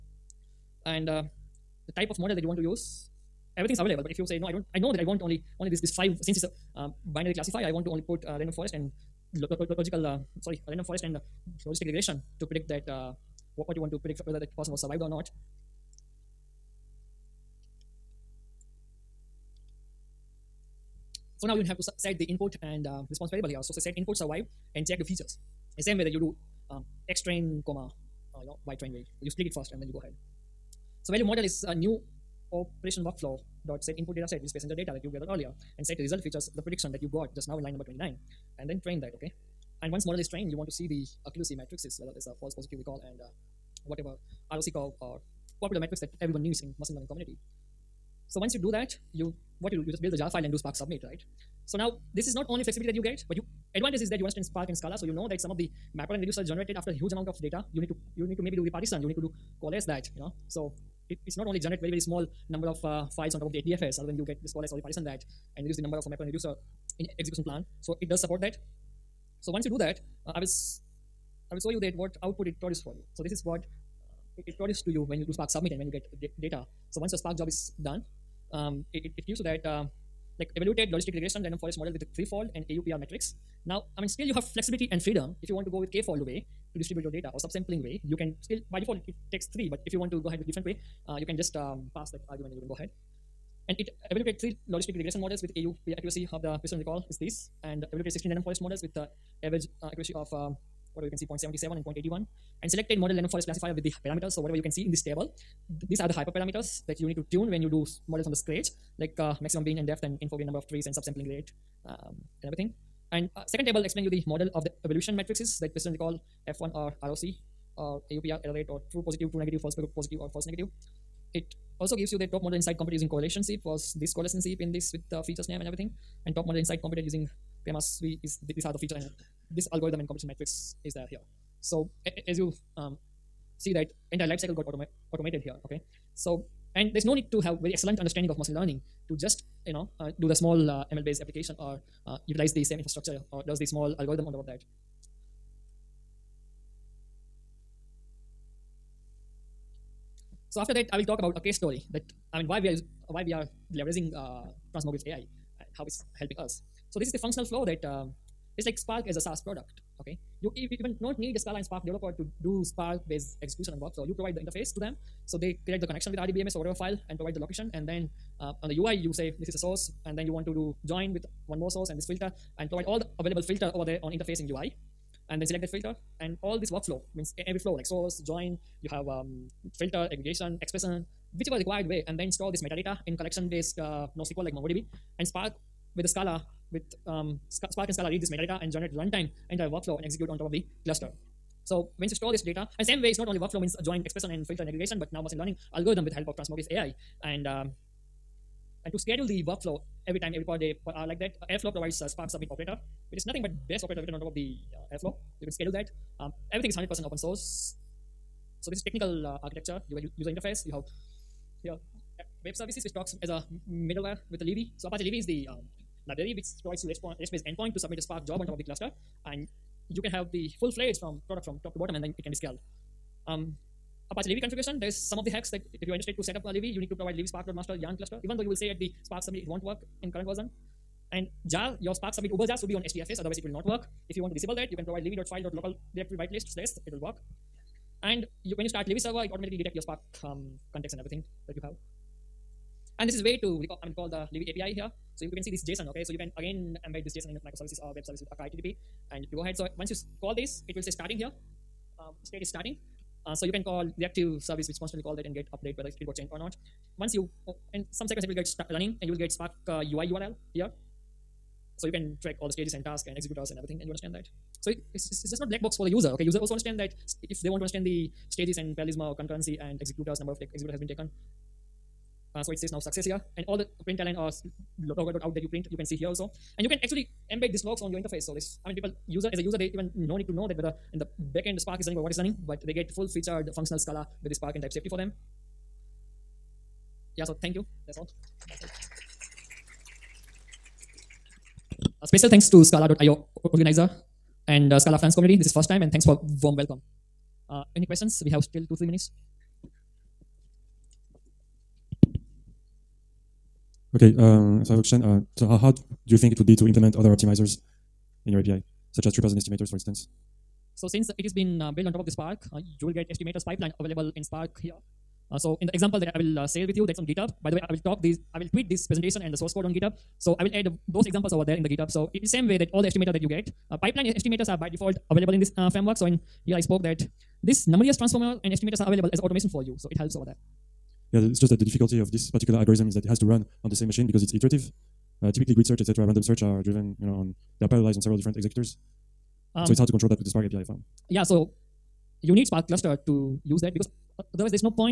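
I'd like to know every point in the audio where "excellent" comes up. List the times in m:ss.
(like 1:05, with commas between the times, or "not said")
2:17.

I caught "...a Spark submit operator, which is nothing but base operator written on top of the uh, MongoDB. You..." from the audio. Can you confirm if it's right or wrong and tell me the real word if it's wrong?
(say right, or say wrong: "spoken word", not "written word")
wrong: "Airflow", not "MongoDB".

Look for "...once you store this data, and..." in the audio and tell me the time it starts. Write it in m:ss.
3:11.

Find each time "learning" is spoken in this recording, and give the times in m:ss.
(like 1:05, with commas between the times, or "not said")
0:46, 2:18, 3:15.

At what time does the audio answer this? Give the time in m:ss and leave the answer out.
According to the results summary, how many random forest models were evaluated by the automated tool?
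1:38.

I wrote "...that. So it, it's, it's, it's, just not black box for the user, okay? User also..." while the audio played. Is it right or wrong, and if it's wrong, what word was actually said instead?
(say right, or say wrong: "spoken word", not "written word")
right.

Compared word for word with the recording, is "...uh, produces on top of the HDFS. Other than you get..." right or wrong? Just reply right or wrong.
wrong.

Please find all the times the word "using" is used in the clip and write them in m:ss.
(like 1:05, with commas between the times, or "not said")
2:02, 2:07.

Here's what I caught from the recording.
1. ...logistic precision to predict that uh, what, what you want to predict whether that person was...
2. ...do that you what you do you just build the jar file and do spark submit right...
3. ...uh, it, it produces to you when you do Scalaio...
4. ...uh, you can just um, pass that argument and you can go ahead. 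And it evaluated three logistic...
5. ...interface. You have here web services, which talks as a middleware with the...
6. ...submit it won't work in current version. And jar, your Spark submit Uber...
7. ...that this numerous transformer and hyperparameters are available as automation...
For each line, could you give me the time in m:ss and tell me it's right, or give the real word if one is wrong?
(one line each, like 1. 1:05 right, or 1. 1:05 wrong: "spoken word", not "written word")
1. 0:11 wrong: "regression", not "precision"
2. 0:48 right
3. 1:13 wrong: "Spark", not "Scalaio"
4. 1:31 right
5. 3:30 right
6. 3:49 right
7. 5:26 wrong: "estimators", not "hyperparameters".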